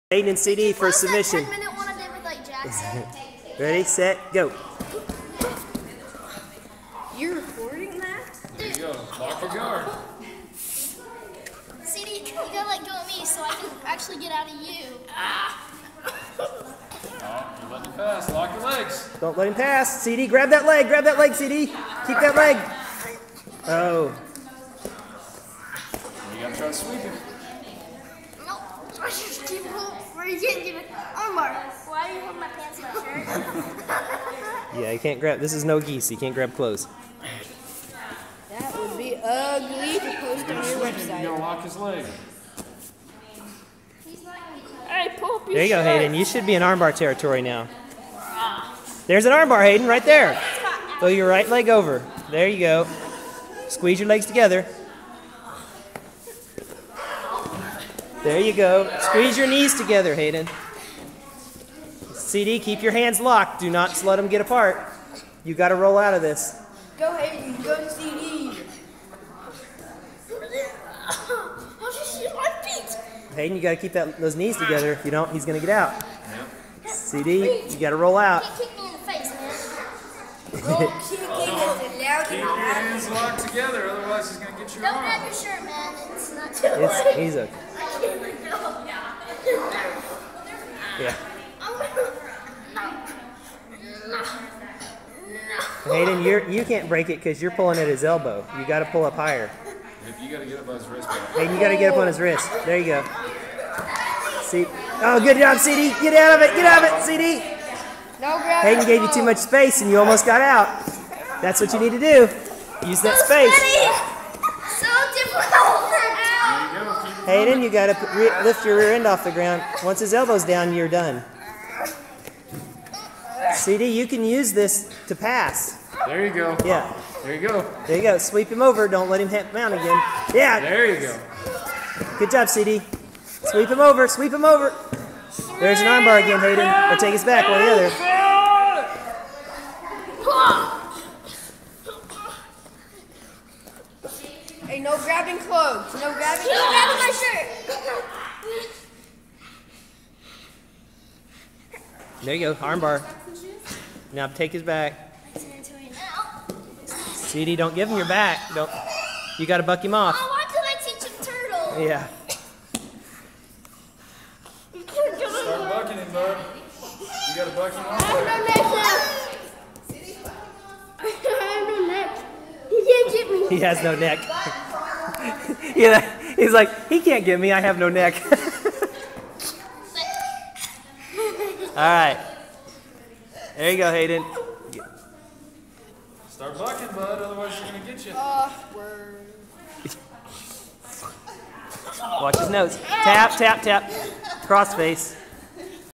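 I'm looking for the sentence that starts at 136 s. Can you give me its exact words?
Or take us back, one or the other.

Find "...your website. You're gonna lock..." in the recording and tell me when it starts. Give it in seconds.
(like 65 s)
40 s.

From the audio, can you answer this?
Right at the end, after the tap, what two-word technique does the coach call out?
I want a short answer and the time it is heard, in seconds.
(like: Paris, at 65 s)
Cross face, at 194 s.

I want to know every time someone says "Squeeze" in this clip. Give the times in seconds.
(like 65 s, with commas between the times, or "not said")
53 s, 58 s.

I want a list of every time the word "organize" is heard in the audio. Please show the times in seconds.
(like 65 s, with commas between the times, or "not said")
not said.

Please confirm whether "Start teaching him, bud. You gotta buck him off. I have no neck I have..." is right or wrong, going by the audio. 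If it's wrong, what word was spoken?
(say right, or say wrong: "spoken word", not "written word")
wrong: "bucking", not "teaching".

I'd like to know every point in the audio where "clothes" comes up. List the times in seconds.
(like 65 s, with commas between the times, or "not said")
36 s, 145 s.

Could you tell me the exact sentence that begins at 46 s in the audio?
You should be in armbar territory now.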